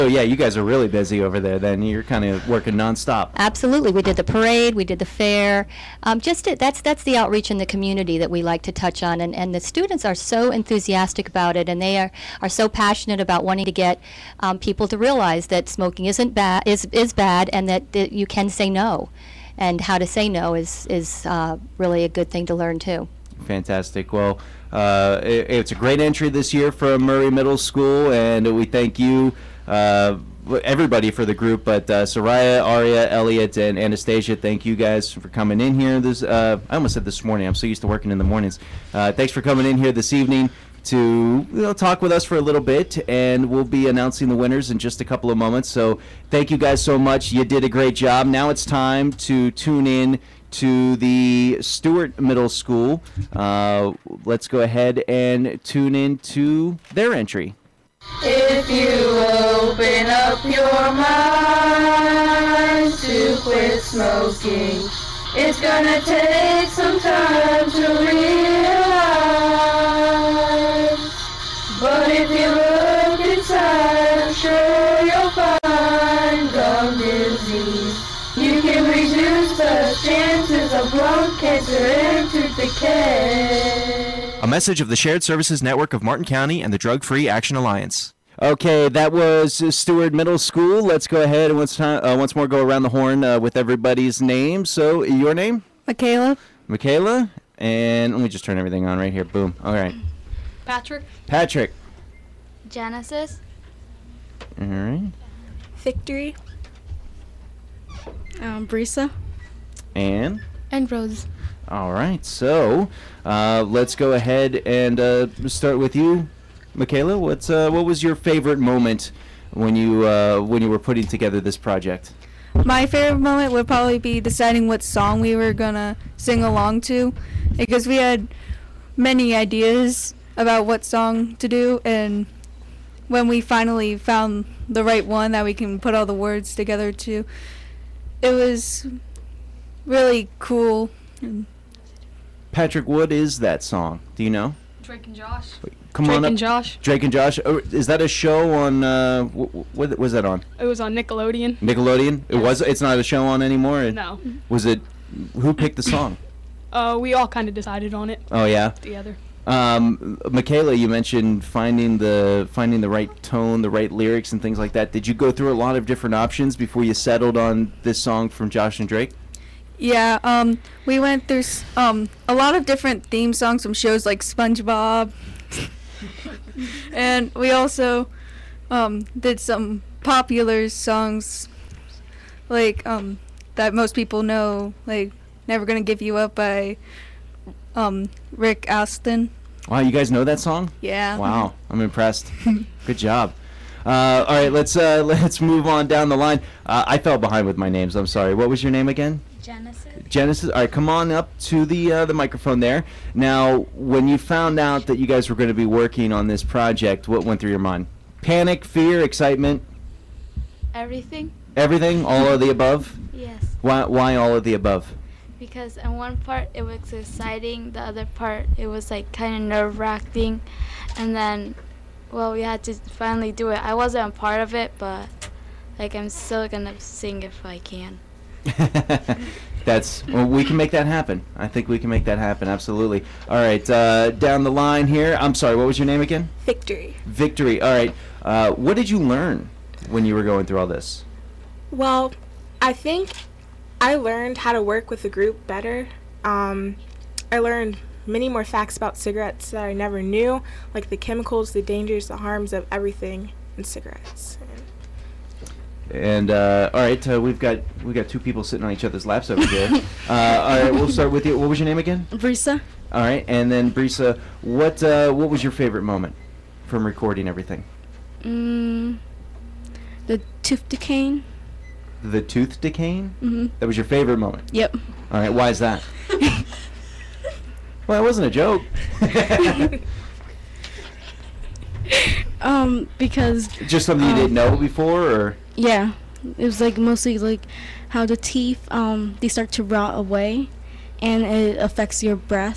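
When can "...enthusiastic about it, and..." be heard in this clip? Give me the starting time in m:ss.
0:10.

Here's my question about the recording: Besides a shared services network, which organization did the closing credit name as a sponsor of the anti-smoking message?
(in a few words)
Drug Free Action Alliance.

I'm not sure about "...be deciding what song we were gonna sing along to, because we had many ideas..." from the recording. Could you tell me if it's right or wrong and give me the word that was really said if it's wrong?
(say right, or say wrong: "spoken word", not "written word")
right.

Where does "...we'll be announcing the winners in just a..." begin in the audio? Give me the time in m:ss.
0:43.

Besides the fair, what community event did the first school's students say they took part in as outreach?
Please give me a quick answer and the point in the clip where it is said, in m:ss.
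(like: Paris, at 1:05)
the parade, at 0:04.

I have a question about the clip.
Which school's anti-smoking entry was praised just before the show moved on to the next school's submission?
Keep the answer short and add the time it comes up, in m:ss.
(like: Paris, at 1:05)
Murray Middle School, at 0:27.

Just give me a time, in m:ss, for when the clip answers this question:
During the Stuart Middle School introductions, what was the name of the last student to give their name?
1:50.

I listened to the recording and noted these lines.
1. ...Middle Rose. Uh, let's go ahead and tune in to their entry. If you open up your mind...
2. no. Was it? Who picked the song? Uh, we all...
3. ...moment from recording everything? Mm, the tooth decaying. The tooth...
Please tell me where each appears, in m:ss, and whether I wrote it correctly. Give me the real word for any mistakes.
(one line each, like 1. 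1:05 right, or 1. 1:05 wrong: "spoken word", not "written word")
1. 0:52 wrong: "School", not "Rose"
2. 2:33 right
3. 4:25 right.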